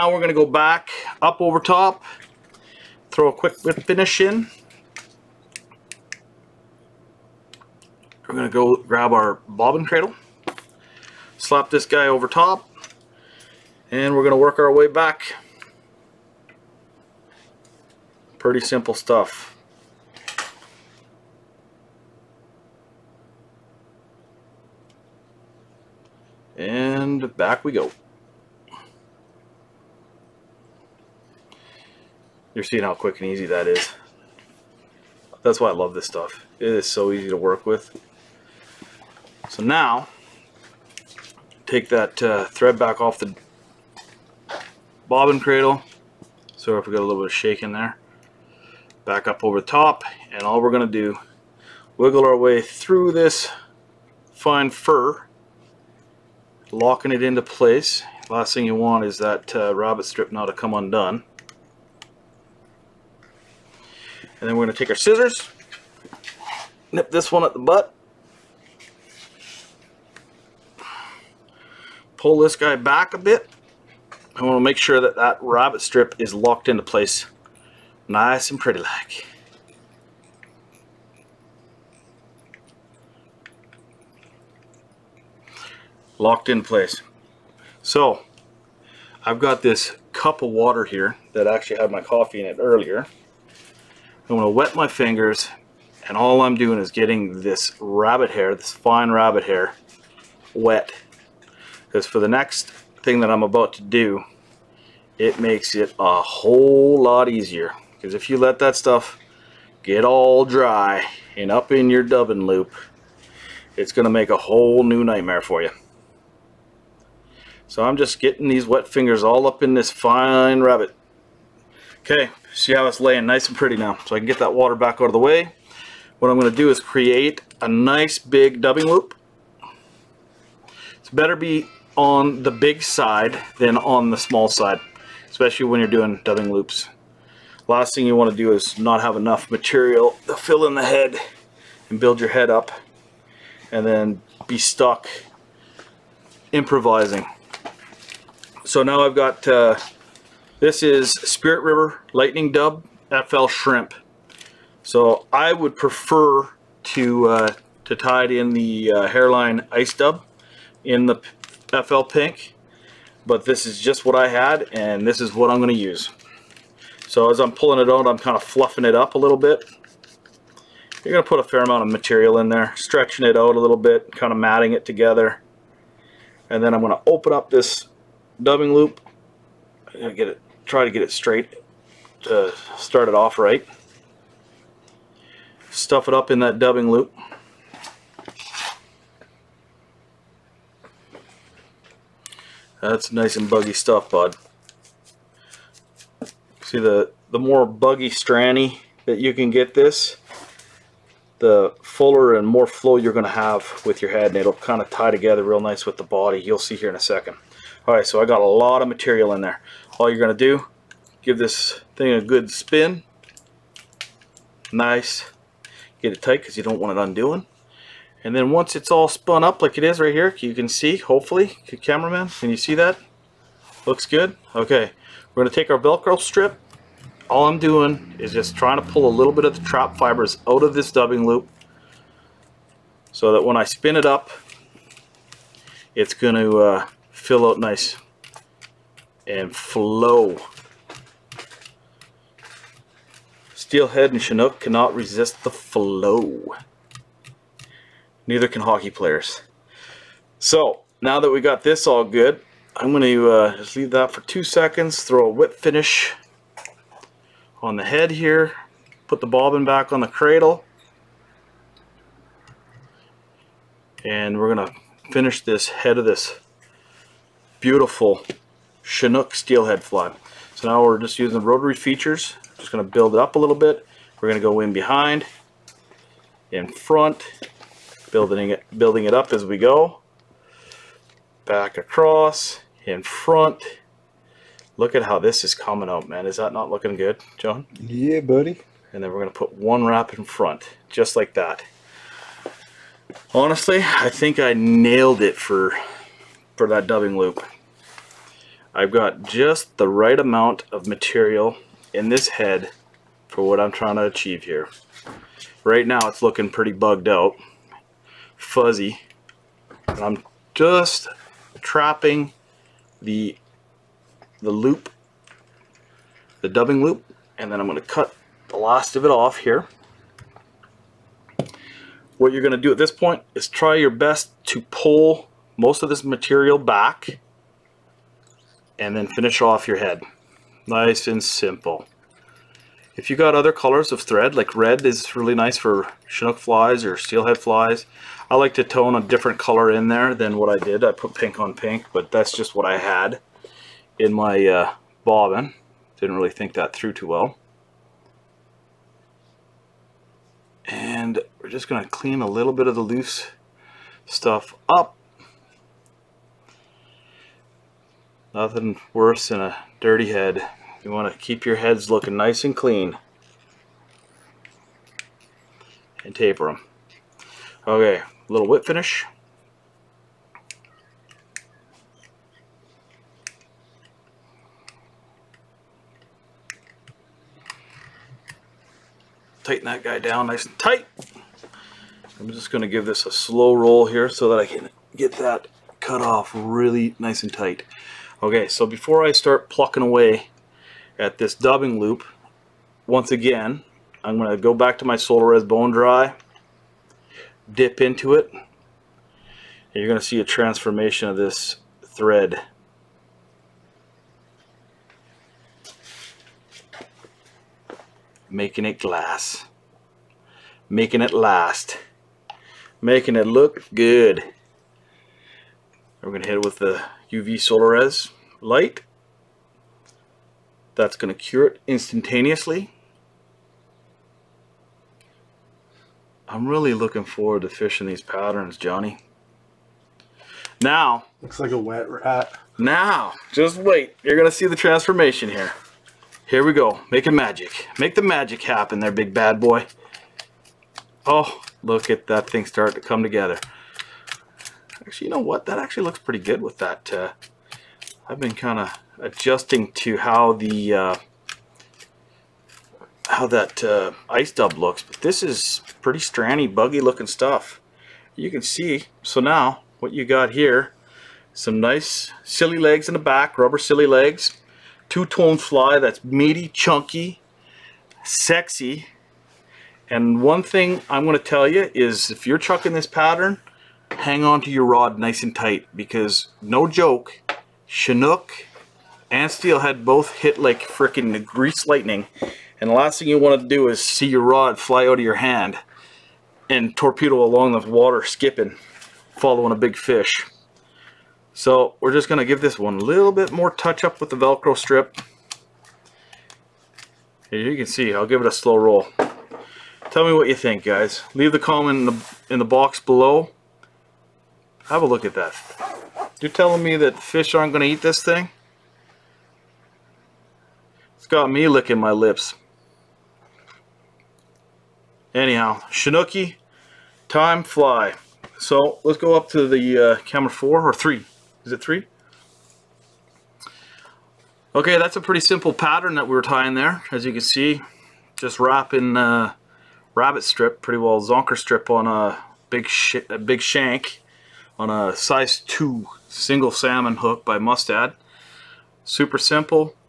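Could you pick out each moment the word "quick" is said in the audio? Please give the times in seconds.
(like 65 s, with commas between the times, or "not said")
3 s, 32 s.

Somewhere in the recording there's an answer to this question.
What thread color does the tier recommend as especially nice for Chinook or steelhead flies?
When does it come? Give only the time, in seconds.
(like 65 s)
334 s.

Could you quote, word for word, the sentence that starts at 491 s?
So we're just going to give this one a little bit more touch up with the Velcro strip.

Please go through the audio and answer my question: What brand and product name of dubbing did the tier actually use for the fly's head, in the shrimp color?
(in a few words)
Spirit River Lightning Dub.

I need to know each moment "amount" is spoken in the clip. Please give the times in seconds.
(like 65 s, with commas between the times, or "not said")
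171 s, 300 s.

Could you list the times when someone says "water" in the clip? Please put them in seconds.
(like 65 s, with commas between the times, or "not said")
90 s, 124 s, 487 s.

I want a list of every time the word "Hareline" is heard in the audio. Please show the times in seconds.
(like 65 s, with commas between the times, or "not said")
159 s.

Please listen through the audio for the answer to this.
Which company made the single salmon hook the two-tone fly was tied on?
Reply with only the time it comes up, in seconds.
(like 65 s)
537 s.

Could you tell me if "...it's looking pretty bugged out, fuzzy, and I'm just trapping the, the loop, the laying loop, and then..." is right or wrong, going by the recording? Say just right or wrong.
wrong.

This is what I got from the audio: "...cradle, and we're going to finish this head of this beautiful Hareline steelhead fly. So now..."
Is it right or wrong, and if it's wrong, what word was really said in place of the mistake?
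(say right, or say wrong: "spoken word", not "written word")
wrong: "Chinook", not "Hareline".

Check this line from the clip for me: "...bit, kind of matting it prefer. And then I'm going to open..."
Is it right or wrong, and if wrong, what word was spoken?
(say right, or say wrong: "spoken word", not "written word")
wrong: "together", not "prefer".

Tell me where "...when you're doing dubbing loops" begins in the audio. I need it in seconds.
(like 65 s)
135 s.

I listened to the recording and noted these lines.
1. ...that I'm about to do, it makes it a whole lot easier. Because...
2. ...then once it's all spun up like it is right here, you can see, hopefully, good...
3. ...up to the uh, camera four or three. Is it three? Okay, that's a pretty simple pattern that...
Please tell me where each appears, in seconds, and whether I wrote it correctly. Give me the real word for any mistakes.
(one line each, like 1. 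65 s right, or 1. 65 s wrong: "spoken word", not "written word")
1. 103 s right
2. 218 s right
3. 519 s right.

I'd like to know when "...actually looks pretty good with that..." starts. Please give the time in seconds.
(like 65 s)
445 s.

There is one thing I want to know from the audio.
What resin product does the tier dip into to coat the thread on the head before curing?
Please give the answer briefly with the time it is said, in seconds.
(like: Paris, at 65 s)
Solarez Bone Dry, at 394 s.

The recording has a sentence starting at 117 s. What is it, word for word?
So I'm just getting these wet fingers all up in this fine rabbit.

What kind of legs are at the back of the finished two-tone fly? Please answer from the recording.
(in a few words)
rubber silly legs.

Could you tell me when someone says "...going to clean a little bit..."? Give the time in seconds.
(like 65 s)
351 s.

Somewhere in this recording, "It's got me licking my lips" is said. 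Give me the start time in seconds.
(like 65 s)
510 s.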